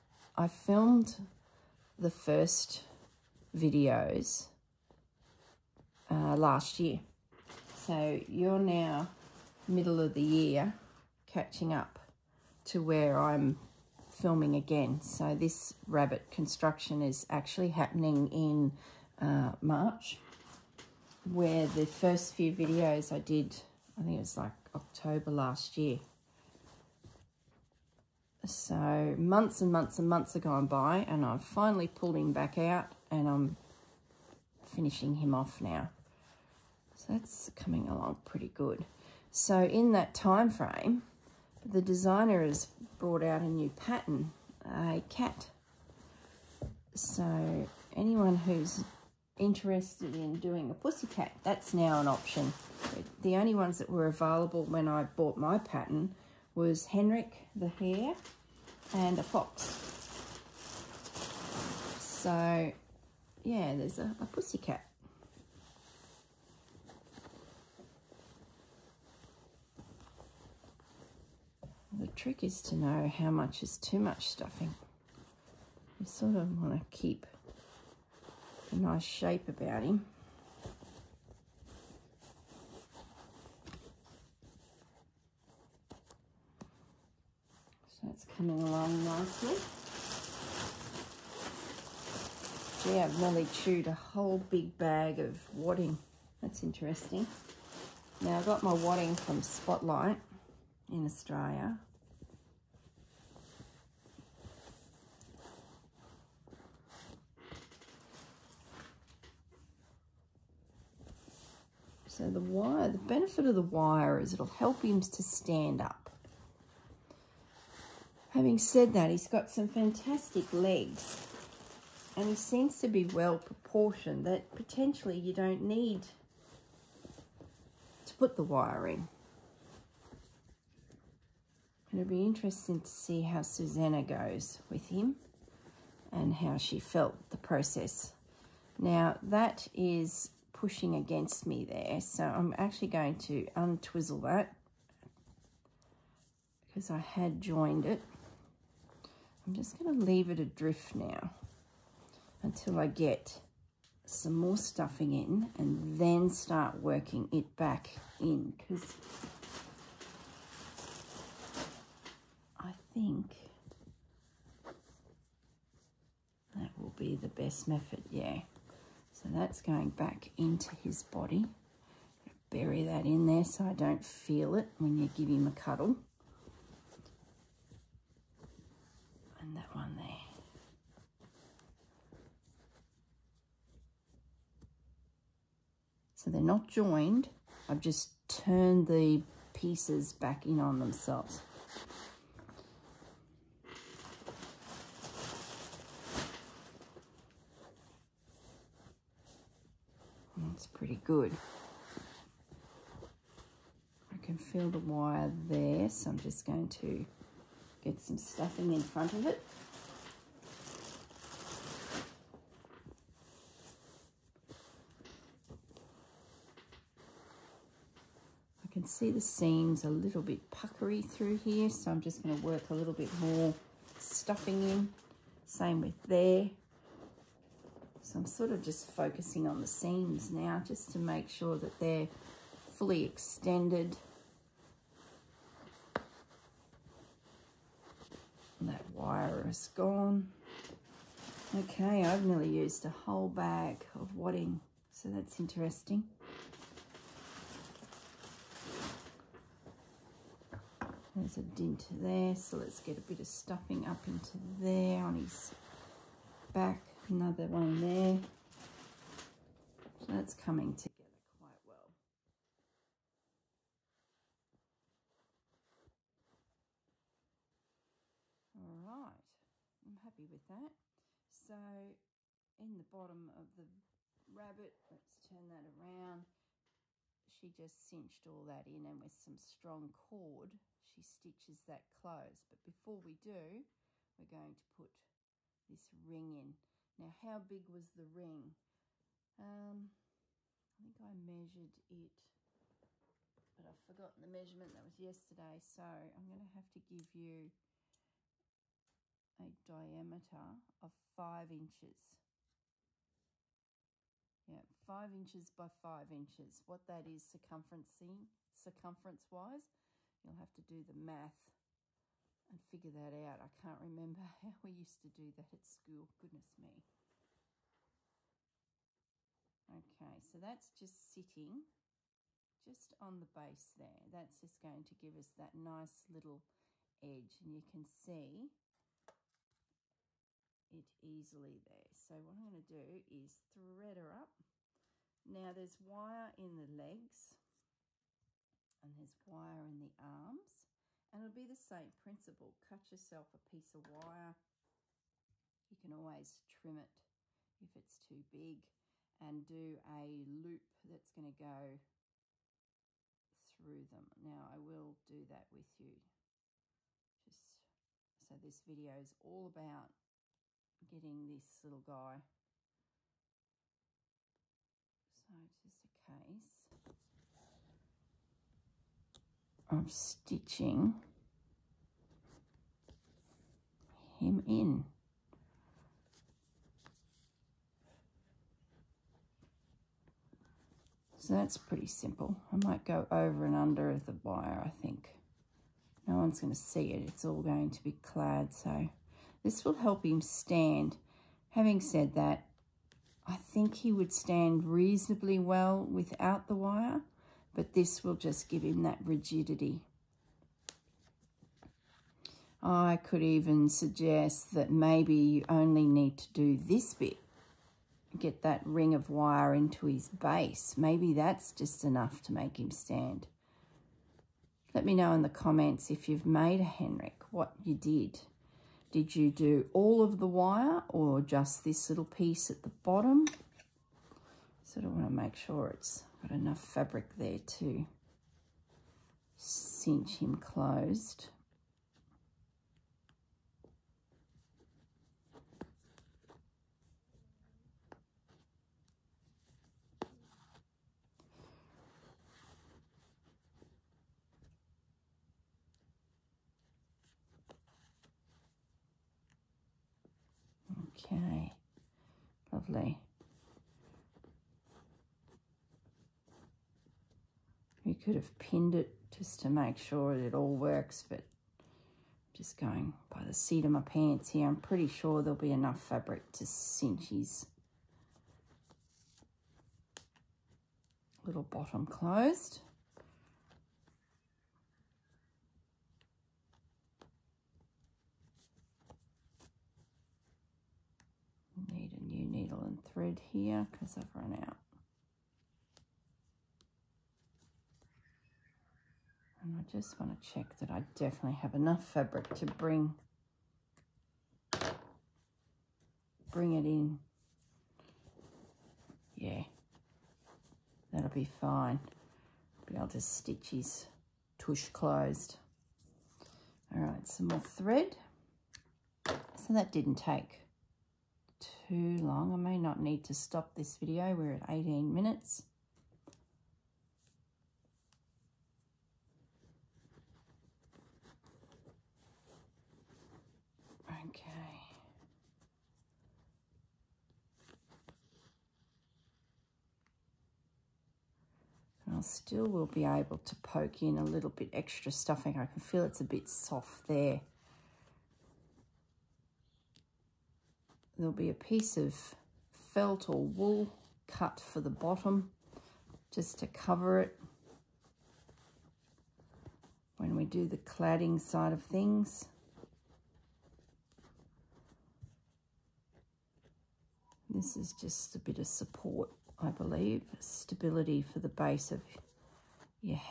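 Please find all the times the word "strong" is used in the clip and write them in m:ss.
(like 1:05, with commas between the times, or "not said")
4:39.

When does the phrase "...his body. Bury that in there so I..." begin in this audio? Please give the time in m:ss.
2:50.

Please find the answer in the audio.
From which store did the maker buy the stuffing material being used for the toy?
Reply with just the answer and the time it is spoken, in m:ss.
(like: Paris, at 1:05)
Spotlight, at 1:39.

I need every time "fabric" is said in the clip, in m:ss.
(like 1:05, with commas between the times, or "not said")
7:06, 7:45, 8:11.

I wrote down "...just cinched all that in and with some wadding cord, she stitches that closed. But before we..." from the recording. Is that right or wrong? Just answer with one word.
wrong.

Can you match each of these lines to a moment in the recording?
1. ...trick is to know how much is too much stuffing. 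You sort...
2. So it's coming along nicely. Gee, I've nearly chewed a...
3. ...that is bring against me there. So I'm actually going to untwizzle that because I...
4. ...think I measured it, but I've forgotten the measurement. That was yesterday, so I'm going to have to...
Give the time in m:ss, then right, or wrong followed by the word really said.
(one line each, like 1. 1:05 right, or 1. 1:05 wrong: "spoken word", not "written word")
1. 1:12 right
2. 1:27 right
3. 2:19 wrong: "pushing", not "bring"
4. 4:50 right.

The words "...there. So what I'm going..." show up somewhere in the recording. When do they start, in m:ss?
5:31.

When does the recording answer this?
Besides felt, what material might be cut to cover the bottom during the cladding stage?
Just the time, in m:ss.
9:03.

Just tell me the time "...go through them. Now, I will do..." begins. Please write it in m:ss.
5:51.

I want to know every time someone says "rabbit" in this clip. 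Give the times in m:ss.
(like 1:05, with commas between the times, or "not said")
0:15, 4:34.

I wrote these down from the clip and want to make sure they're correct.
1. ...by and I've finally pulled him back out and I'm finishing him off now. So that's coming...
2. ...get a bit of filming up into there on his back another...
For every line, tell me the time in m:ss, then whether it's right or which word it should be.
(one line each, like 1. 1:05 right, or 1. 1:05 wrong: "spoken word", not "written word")
1. 0:30 right
2. 4:12 wrong: "stuffing", not "filming".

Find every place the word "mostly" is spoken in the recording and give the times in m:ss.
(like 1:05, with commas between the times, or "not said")
not said.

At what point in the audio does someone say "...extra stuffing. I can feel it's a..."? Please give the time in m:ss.
8:54.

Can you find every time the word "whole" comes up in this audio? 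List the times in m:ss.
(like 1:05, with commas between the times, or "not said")
1:33, 4:02.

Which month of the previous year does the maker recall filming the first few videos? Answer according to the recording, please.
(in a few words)
October.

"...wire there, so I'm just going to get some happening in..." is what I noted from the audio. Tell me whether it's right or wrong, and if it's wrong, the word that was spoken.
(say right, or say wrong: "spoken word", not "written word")
wrong: "stuffing", not "happening".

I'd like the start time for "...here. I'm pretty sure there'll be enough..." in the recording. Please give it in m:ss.
7:44.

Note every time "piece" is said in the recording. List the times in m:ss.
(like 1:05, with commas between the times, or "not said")
3:09, 5:43, 7:02, 9:01.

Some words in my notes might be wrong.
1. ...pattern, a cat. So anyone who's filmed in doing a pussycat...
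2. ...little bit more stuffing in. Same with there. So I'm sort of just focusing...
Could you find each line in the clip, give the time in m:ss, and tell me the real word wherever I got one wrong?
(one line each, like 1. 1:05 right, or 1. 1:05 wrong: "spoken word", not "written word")
1. 0:43 wrong: "interested", not "filmed"
2. 3:42 right.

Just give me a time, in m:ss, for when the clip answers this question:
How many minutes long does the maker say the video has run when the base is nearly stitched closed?
8:34.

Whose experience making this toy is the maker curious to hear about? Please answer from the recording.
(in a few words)
Susanna.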